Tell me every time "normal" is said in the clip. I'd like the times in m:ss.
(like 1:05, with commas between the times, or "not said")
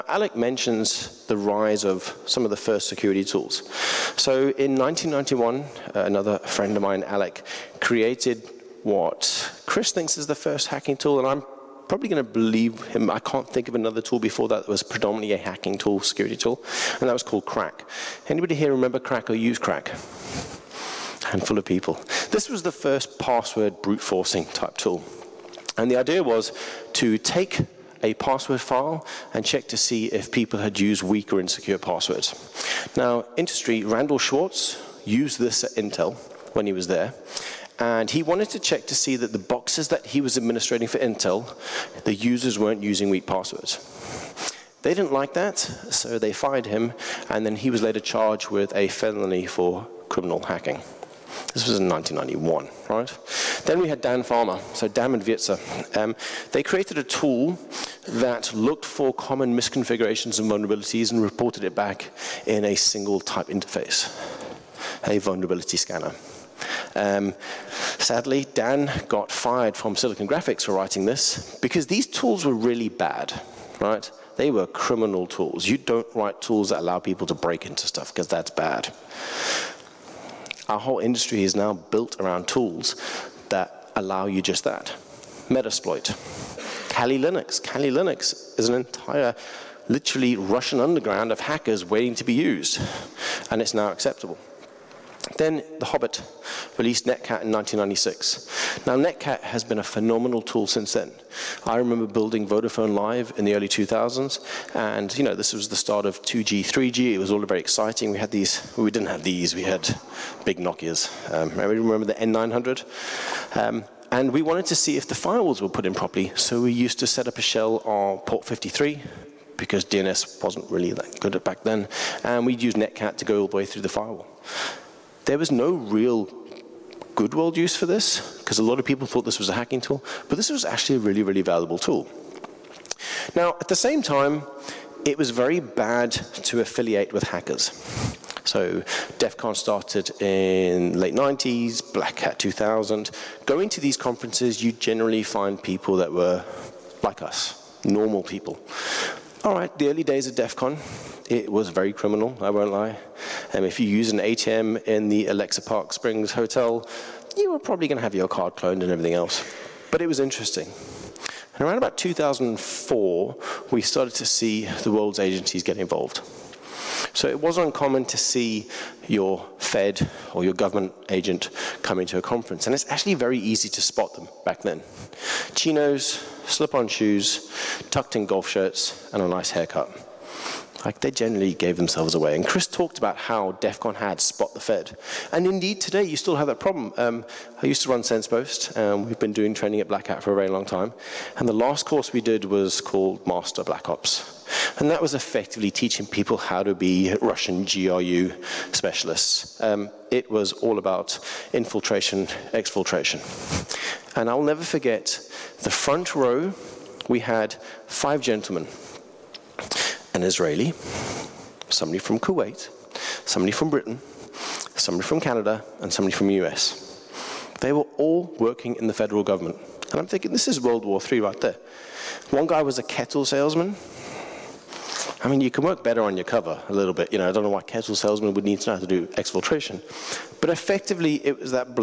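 2:27.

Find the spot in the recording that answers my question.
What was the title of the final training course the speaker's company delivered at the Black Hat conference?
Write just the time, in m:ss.
3:13.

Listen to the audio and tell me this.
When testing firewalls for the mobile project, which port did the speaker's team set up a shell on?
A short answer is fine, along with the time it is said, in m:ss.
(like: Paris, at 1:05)
53, at 1:58.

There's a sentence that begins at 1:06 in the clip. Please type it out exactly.
Um, sadly, Dan got fired from Silicon Graphics for writing this because these tools were really bad, right?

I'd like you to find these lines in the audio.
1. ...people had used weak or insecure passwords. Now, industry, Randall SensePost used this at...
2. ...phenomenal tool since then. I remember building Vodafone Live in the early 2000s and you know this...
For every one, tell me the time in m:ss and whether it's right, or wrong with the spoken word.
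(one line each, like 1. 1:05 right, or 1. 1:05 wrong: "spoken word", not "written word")
1. 0:30 wrong: "Schwartz", not "SensePost"
2. 1:39 right.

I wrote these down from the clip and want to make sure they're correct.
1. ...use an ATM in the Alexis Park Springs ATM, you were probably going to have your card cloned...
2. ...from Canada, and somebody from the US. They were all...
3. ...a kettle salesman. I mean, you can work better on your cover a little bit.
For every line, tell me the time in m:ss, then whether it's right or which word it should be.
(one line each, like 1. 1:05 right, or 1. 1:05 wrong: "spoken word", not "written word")
1. 2:33 wrong: "Hotel", not "ATM"
2. 3:35 right
3. 3:42 right.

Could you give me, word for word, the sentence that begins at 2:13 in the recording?
Now, at the same time, it was very bad to affiliate with hackers.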